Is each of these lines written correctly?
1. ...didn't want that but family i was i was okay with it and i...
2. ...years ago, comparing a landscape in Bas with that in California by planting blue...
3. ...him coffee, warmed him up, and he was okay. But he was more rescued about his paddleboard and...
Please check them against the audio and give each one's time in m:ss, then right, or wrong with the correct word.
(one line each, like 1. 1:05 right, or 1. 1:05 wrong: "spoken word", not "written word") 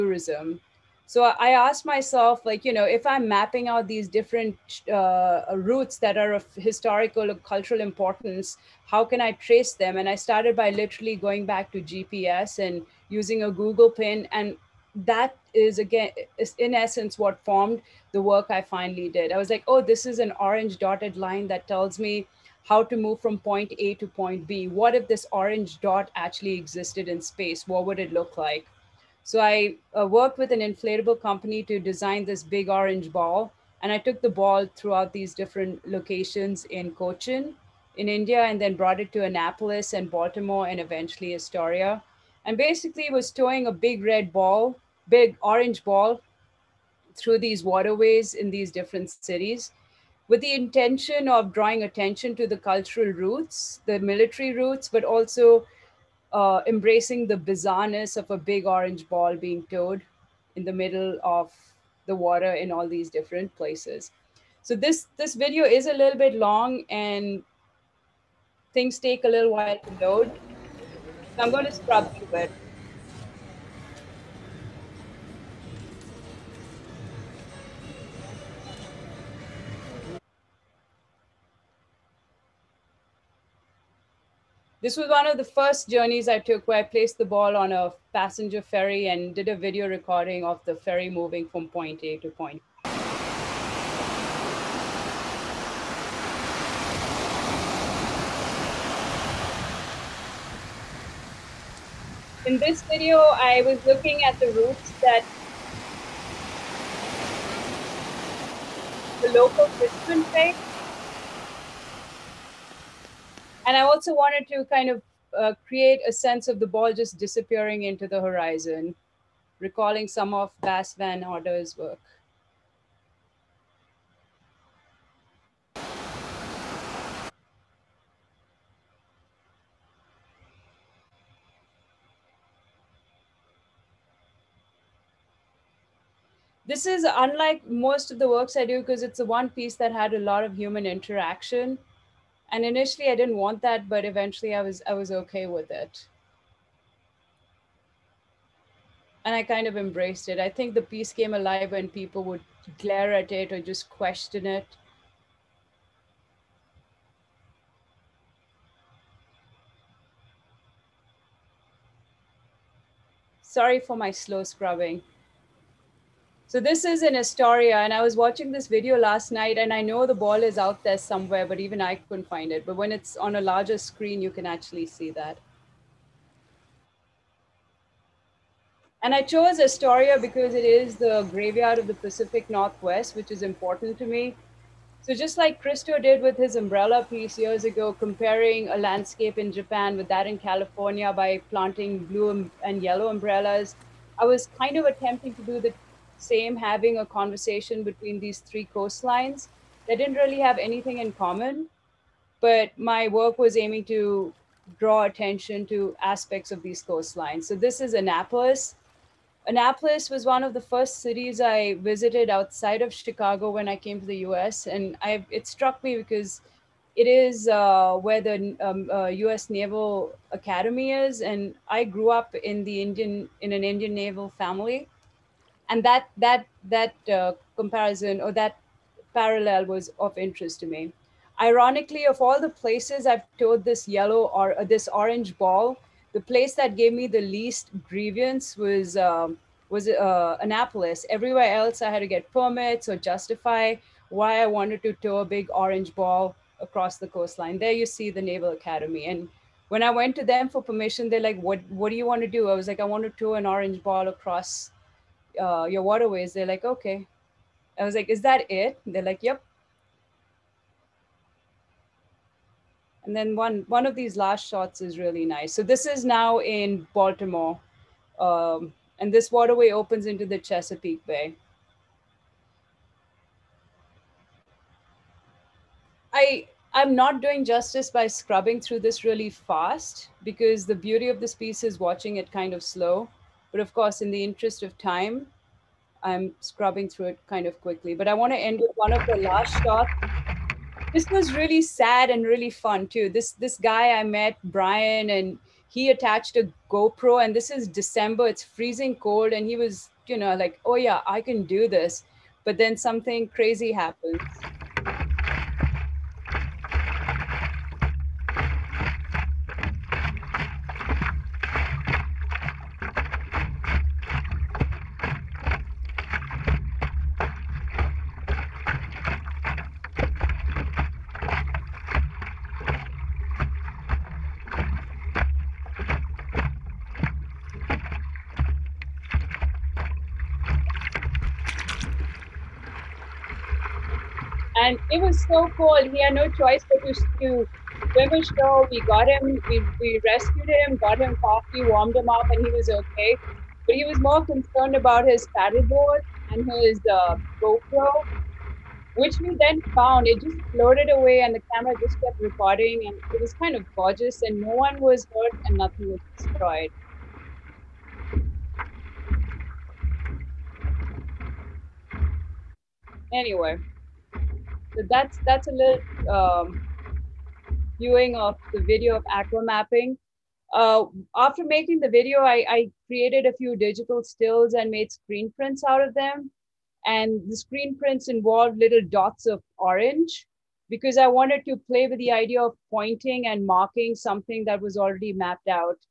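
1. 2:23 wrong: "eventually", not "family"
2. 3:07 wrong: "Japan", not "Bas"
3. 5:40 wrong: "concerned", not "rescued".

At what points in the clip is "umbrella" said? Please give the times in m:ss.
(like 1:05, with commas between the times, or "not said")
3:06, 3:13.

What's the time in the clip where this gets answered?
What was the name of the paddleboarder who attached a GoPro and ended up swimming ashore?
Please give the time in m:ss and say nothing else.
4:54.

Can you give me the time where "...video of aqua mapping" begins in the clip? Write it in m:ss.
6:08.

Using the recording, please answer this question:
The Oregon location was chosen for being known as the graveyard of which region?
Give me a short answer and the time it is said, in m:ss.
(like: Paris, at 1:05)
Pacific Northwest, at 3:01.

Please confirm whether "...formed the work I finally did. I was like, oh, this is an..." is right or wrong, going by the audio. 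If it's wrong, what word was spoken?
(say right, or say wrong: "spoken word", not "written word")
right.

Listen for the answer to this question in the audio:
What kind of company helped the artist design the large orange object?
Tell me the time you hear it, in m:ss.
0:30.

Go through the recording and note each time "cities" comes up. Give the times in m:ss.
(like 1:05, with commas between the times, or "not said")
0:49, 3:30.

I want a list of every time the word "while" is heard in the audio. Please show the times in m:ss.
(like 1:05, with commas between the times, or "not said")
1:09.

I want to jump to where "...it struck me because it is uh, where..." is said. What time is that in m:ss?
3:35.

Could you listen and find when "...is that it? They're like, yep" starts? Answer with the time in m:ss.
4:18.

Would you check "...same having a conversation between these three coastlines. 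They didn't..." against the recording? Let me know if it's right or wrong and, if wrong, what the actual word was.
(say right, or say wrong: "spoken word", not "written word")
right.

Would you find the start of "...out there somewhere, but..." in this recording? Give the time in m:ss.
2:50.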